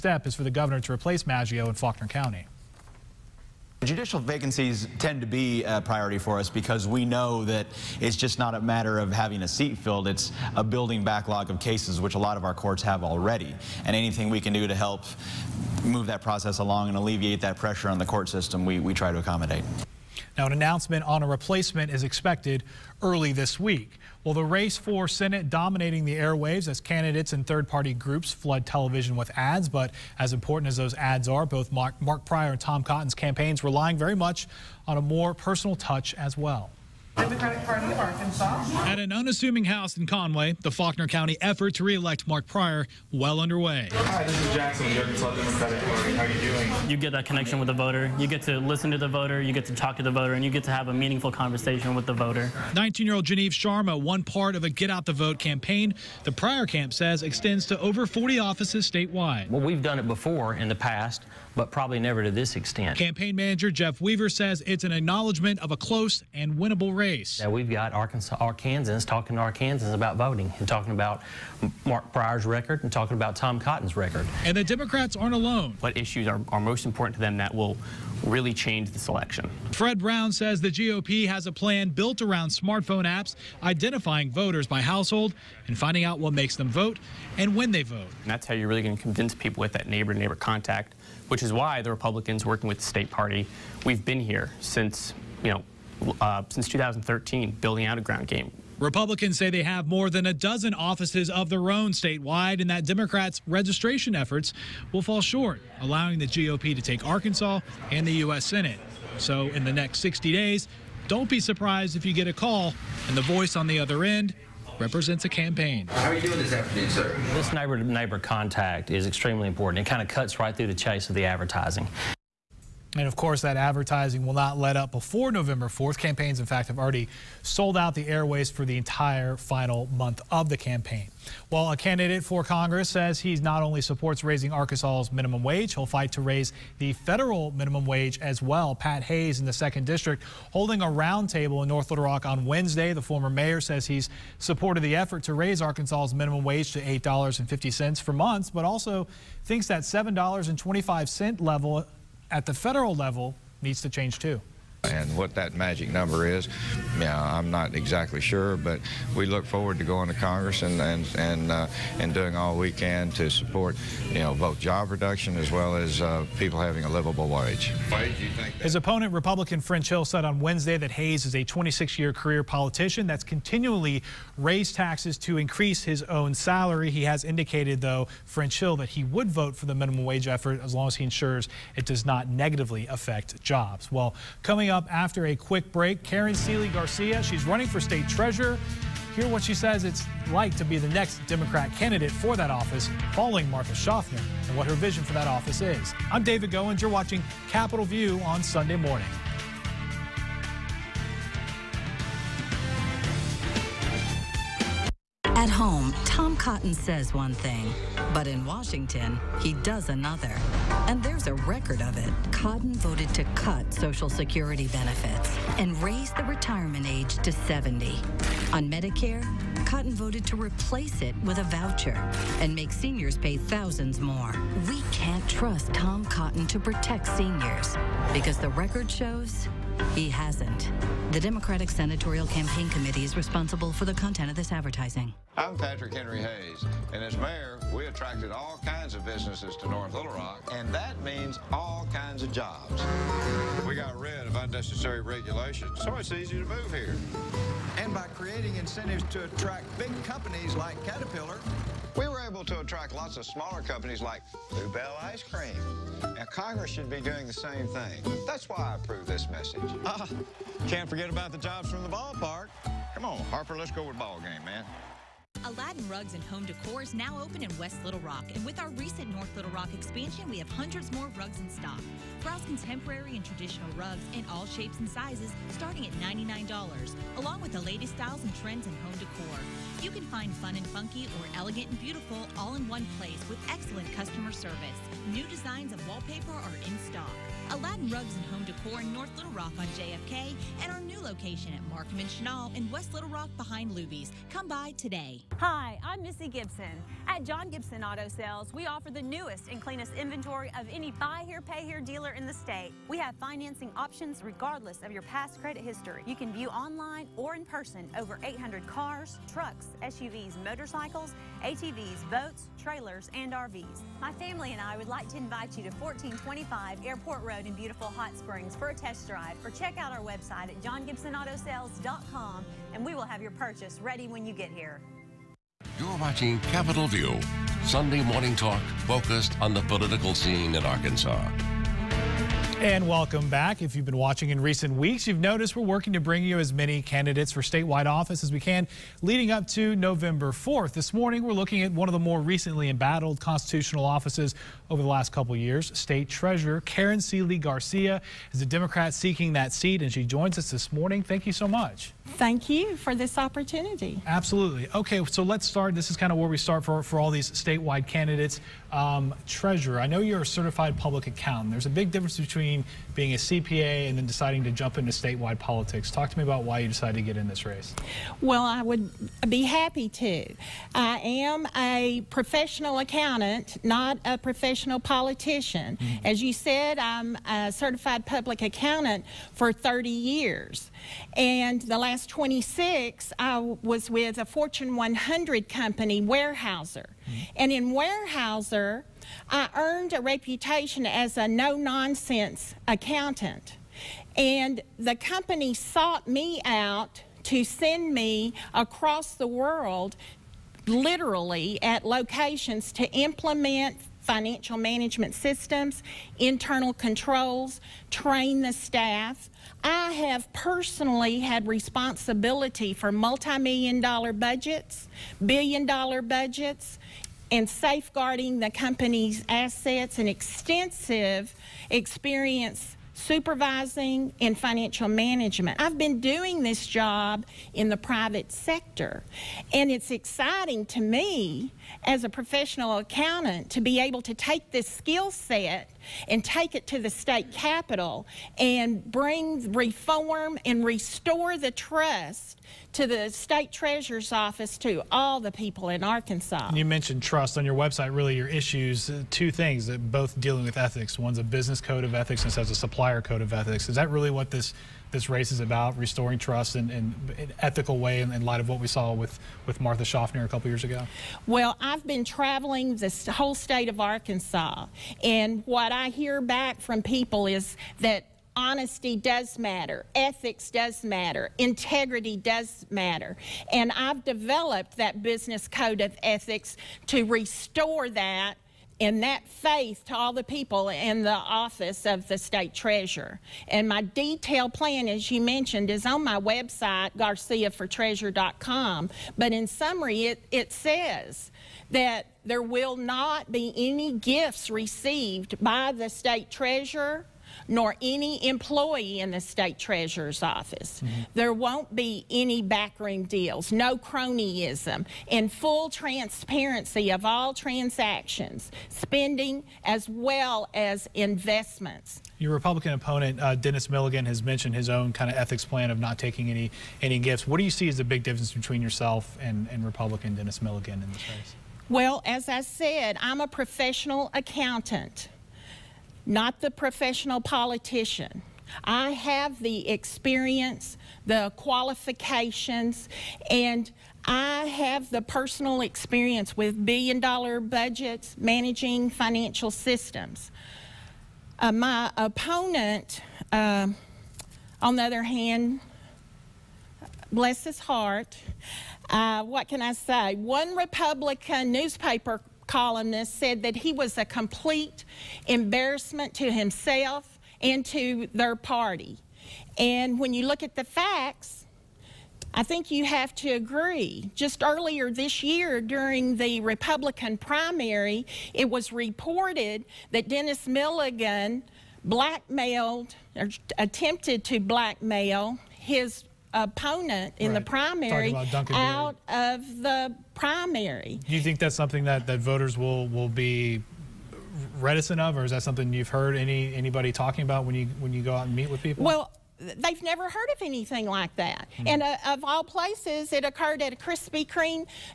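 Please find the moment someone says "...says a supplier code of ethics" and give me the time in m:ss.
7:32.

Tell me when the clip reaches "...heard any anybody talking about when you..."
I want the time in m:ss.
9:45.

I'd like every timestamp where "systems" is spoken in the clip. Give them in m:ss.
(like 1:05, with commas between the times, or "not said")
0:18, 6:45, 8:59.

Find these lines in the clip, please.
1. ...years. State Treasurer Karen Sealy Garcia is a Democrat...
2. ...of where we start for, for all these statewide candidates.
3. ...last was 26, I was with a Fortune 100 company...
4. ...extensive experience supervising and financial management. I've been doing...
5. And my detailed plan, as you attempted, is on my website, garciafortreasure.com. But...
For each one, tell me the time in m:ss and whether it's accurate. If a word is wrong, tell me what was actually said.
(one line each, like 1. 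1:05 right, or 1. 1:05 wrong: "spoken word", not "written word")
1. 5:45 right
2. 5:56 right
3. 6:21 right
4. 7:00 right
5. 8:03 wrong: "mentioned", not "attempted".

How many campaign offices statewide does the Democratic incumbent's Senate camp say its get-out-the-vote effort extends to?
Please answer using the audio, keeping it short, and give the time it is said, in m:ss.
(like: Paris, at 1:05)
over 40, at 0:57.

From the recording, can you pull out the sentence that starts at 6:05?
Talk to me about why you decided to get in this race.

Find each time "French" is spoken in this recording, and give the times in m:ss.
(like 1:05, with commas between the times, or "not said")
2:49, 2:58.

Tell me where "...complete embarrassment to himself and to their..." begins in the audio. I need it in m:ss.
9:14.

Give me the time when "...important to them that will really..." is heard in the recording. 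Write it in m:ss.
1:16.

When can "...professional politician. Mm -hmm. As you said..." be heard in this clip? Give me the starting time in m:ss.
6:14.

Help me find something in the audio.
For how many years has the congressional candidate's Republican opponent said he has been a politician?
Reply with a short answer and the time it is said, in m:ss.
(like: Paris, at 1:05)
26, at 2:51.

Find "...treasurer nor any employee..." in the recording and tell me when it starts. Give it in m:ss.
8:16.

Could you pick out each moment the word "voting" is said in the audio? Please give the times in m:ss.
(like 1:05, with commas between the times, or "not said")
1:10.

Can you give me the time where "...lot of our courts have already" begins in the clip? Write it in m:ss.
0:12.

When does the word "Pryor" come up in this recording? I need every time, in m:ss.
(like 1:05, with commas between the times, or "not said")
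0:32, 0:42, 0:56, 1:12.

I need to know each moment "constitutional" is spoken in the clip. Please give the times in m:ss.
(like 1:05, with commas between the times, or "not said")
5:43.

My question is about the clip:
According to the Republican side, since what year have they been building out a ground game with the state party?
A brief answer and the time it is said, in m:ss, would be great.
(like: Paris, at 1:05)
2013, at 1:36.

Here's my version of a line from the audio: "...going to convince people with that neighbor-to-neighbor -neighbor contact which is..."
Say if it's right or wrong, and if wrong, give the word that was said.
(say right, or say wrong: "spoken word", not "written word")
right.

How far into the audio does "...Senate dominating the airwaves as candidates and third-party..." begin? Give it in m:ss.
0:25.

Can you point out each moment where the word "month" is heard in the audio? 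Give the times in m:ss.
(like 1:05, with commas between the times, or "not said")
2:09, 2:28.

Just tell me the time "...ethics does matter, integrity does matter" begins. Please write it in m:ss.
7:49.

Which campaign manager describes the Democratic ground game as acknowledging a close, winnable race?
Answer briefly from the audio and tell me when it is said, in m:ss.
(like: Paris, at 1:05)
Jeff Weaver, at 1:03.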